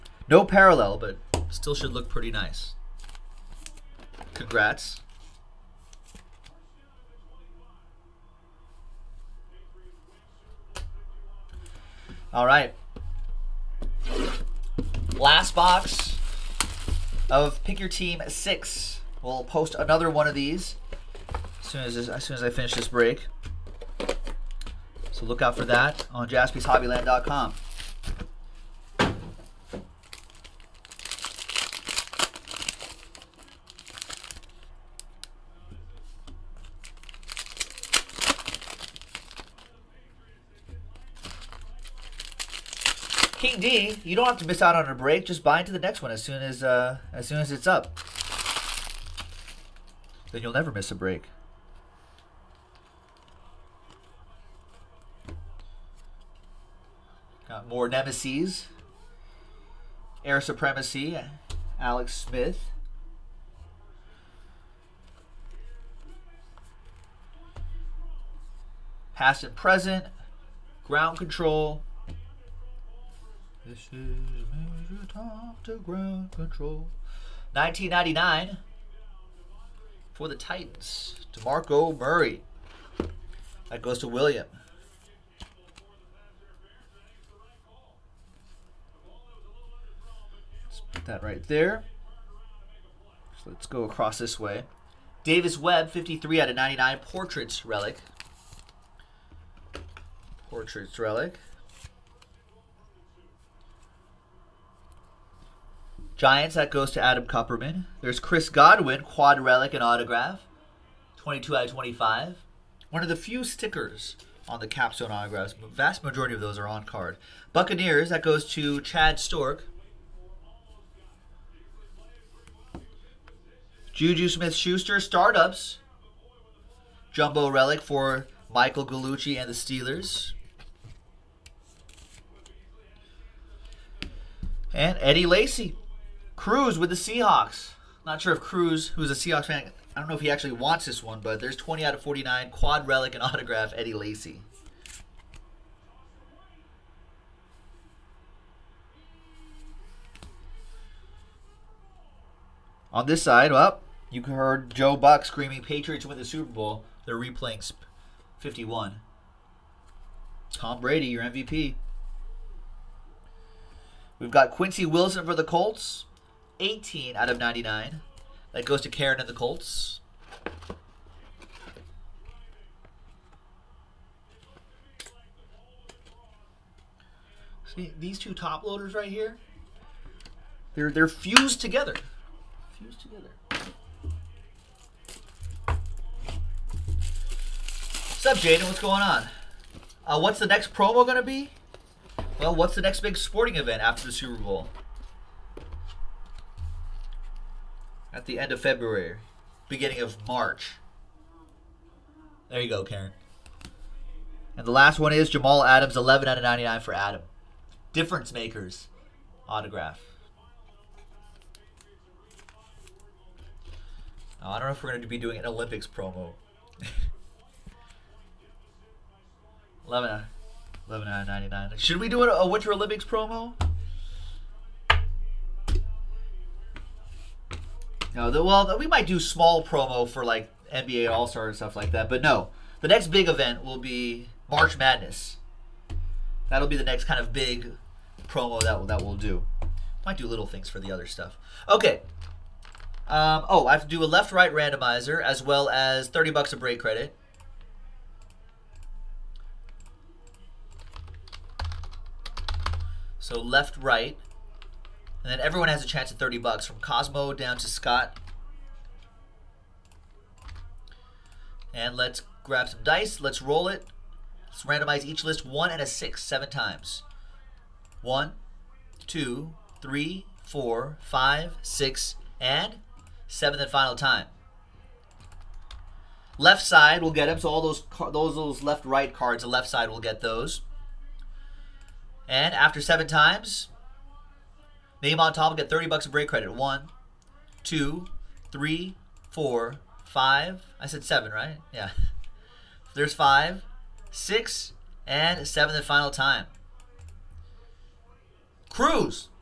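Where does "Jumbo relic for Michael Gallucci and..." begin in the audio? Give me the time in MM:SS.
02:07.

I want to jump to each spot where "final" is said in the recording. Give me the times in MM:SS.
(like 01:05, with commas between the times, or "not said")
04:33, 04:55.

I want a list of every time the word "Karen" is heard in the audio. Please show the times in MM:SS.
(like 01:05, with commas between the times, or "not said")
02:48, 03:22.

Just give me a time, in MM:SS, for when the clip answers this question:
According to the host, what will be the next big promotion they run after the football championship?
03:54.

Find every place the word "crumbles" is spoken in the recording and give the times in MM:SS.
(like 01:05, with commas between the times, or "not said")
not said.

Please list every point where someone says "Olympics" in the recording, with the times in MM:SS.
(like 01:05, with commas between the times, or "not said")
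03:35, 03:42.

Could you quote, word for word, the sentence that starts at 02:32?
On this side, well, you heard Joe Buck screaming, Patriots win the Super Bowl.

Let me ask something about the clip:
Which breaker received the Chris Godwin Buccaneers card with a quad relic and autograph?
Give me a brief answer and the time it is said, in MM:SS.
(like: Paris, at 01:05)
Chad Stork, at 01:58.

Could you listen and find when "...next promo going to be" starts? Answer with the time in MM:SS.
03:10.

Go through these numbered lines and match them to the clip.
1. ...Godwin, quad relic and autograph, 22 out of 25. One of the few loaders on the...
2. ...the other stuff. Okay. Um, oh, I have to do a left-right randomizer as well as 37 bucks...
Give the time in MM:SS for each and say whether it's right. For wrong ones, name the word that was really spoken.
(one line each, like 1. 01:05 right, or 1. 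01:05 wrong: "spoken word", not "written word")
1. 01:48 wrong: "stickers", not "loaders"
2. 04:00 wrong: "30", not "37".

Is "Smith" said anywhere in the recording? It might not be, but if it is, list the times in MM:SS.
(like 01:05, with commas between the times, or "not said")
01:02, 02:04.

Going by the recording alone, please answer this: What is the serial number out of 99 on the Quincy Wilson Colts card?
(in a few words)
18.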